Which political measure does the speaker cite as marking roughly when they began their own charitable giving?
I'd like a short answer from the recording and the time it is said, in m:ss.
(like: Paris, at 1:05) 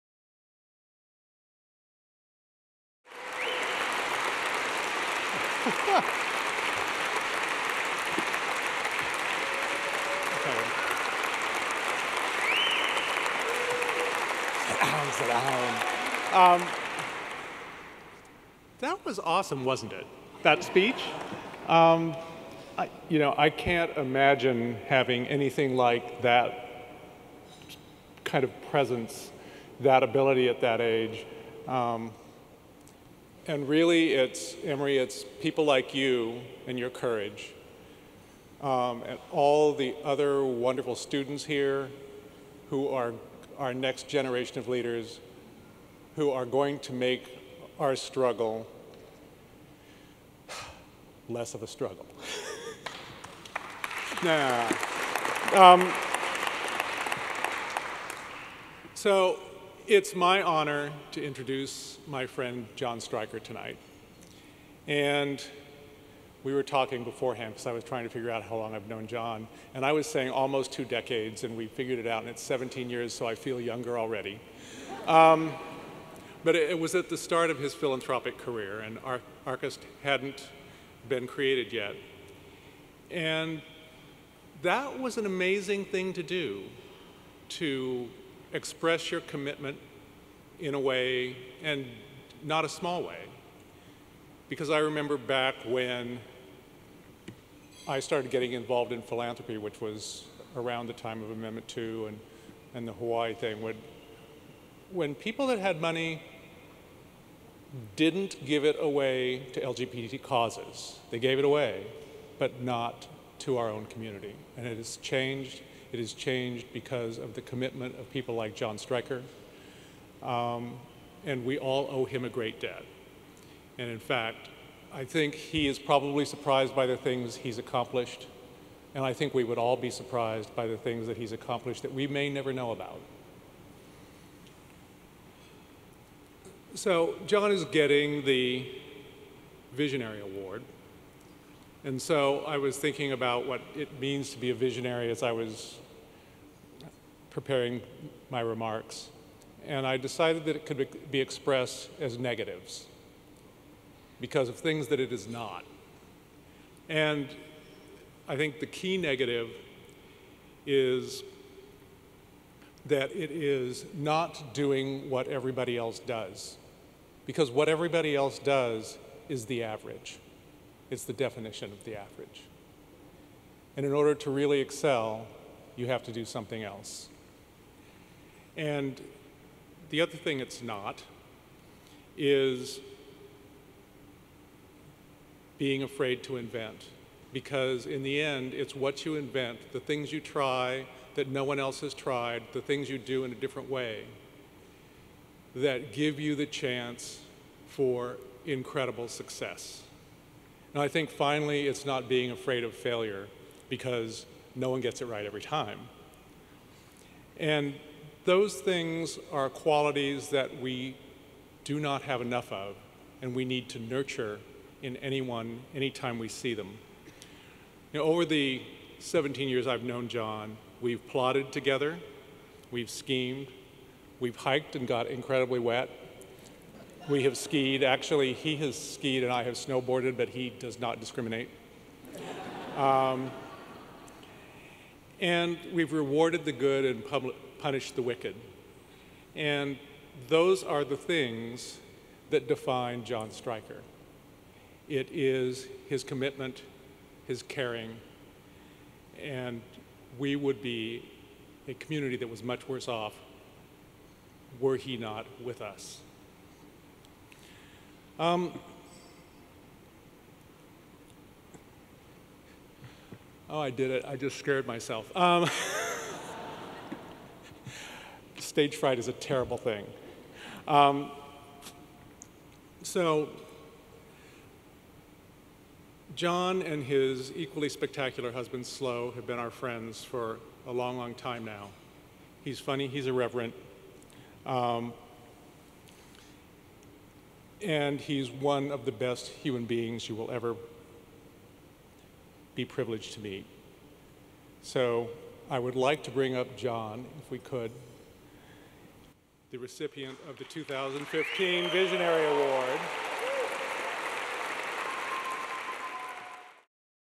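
Amendment 2, at 1:41.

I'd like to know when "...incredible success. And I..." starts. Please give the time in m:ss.
3:18.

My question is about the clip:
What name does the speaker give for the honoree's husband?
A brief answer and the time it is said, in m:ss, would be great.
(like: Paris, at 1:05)
Slow, at 4:38.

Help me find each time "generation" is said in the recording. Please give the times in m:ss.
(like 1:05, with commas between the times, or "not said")
0:44.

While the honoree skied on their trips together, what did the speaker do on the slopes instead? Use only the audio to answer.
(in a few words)
Snowboarded.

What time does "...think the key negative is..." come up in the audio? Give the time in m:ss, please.
2:38.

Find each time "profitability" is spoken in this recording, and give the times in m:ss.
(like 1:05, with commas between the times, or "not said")
not said.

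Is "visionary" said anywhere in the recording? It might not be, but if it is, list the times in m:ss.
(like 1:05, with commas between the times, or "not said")
2:19, 2:24, 5:01.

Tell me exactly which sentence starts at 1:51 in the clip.
They gave it away, but not to our own community.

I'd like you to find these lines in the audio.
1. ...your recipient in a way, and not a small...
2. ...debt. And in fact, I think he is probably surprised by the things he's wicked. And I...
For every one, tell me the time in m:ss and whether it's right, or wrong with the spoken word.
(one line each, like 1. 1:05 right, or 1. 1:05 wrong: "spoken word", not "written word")
1. 1:29 wrong: "commitment", not "recipient"
2. 2:02 wrong: "accomplished", not "wicked".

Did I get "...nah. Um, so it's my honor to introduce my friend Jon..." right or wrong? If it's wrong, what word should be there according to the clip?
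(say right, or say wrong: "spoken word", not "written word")
right.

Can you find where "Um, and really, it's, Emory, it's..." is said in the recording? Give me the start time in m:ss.
0:31.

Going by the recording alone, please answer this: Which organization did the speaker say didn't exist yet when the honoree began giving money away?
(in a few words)
Arcus.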